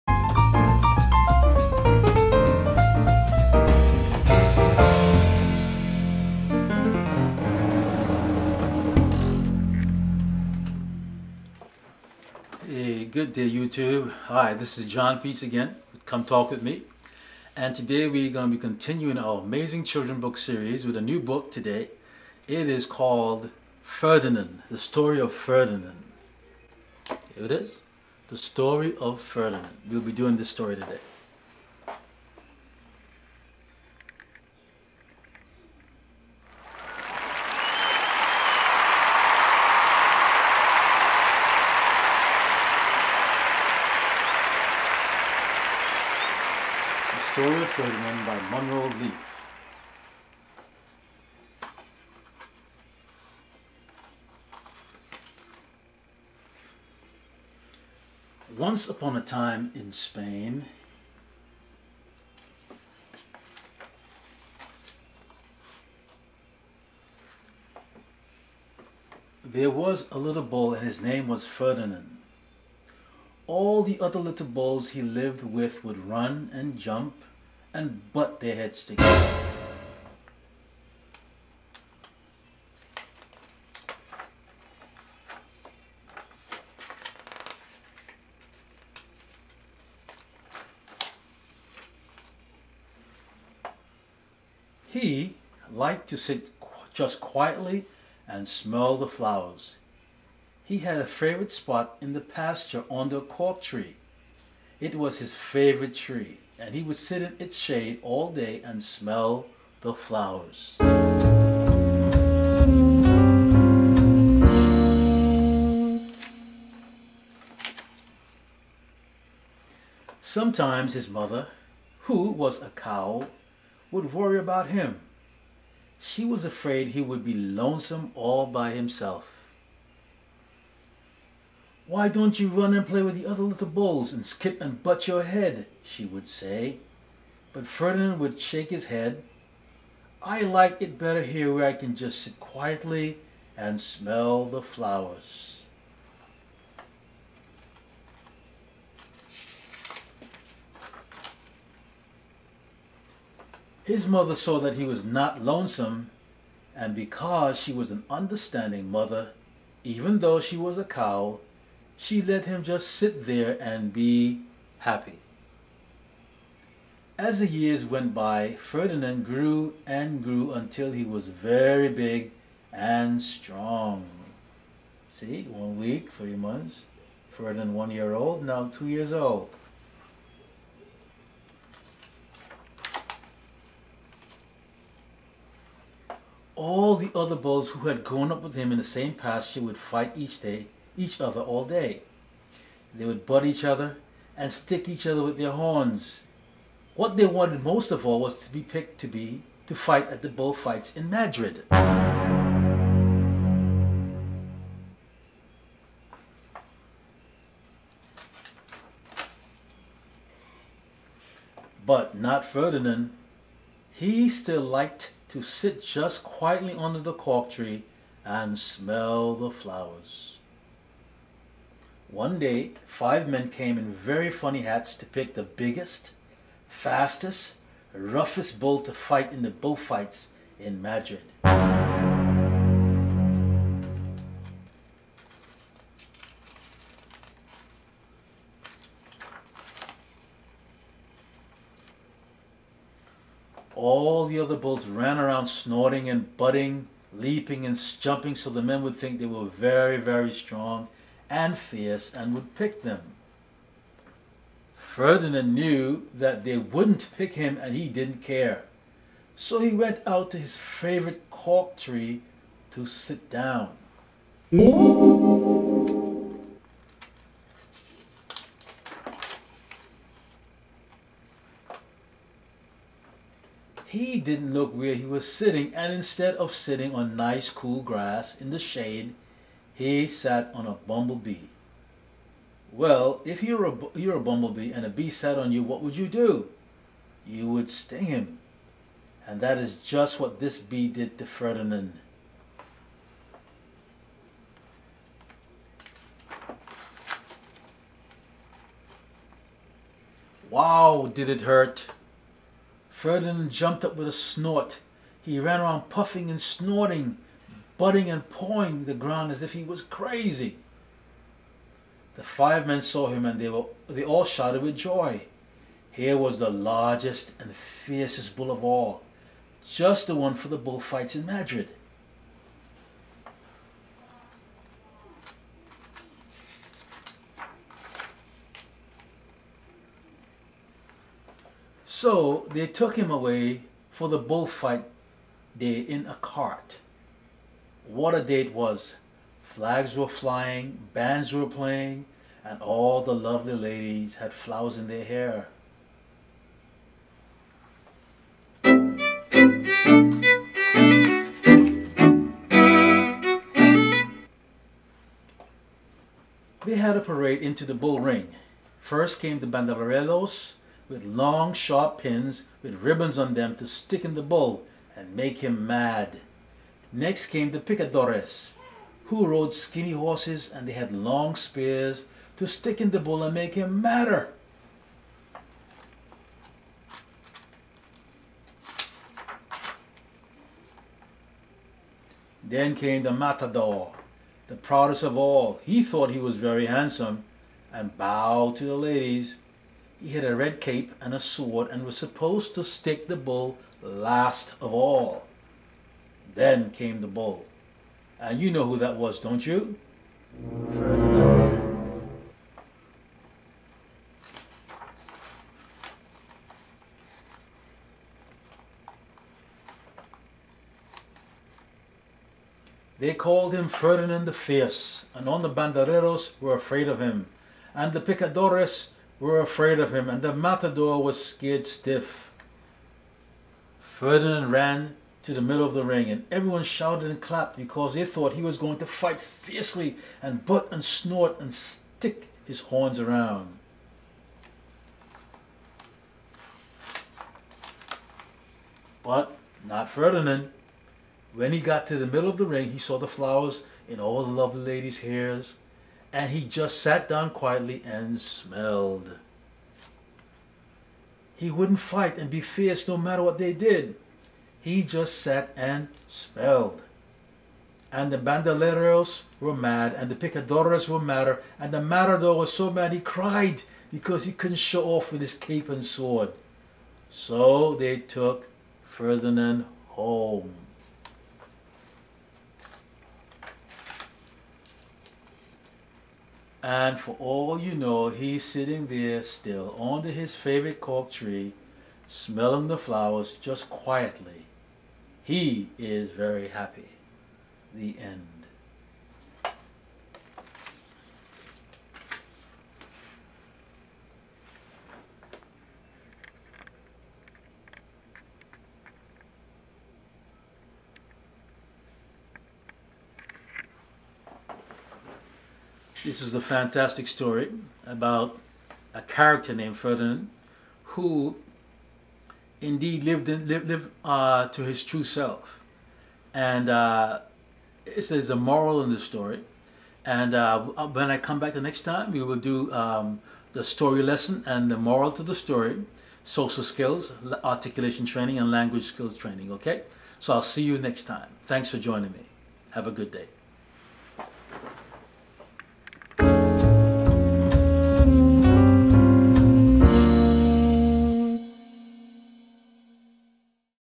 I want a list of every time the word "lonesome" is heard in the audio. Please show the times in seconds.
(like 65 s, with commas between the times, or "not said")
127 s, 155 s.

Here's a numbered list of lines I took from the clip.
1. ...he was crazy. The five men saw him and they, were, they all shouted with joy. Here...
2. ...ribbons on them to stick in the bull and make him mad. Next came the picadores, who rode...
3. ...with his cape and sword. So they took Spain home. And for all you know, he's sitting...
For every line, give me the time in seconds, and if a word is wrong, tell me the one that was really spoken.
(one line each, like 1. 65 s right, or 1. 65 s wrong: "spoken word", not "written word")
1. 309 s right
2. 362 s right
3. 465 s wrong: "Ferdinand", not "Spain".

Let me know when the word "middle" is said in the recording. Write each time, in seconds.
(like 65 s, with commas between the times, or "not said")
425 s, 442 s.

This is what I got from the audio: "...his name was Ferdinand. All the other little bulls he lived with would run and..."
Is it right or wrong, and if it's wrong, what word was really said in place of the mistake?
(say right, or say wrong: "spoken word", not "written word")
right.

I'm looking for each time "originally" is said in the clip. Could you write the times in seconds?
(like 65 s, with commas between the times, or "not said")
not said.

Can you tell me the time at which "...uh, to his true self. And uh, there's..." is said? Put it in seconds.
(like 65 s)
514 s.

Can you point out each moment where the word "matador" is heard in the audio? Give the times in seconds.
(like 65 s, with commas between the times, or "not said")
383 s, 420 s, 461 s.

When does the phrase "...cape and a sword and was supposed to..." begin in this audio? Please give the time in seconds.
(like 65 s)
390 s.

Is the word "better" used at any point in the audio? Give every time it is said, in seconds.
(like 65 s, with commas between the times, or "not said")
140 s.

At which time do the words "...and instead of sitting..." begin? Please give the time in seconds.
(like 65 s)
275 s.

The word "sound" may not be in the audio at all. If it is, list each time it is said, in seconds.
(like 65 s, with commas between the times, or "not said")
not said.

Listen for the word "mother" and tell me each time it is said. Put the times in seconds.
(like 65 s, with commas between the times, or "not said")
121 s, 154 s, 158 s.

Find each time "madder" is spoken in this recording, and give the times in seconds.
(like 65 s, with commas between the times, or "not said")
373 s, 460 s.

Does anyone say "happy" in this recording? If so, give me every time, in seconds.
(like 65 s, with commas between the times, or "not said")
164 s, 486 s.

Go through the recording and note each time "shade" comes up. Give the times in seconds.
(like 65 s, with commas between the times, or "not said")
107 s, 278 s.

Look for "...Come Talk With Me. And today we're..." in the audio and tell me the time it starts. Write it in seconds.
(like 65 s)
16 s.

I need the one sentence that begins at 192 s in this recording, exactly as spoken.
They would butt each other and stick each other with their horns.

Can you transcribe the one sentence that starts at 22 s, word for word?
It is called Ferdinand, The Story of Ferdinand.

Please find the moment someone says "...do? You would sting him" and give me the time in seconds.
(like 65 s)
286 s.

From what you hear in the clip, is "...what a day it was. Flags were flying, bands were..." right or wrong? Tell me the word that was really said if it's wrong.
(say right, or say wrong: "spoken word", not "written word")
right.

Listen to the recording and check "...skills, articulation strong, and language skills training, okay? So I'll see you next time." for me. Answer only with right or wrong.
wrong.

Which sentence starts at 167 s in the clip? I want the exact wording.
As the years went by, Ferdinand grew and grew until he was very big and strong.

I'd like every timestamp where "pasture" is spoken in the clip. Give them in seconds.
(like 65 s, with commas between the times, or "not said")
102 s, 189 s.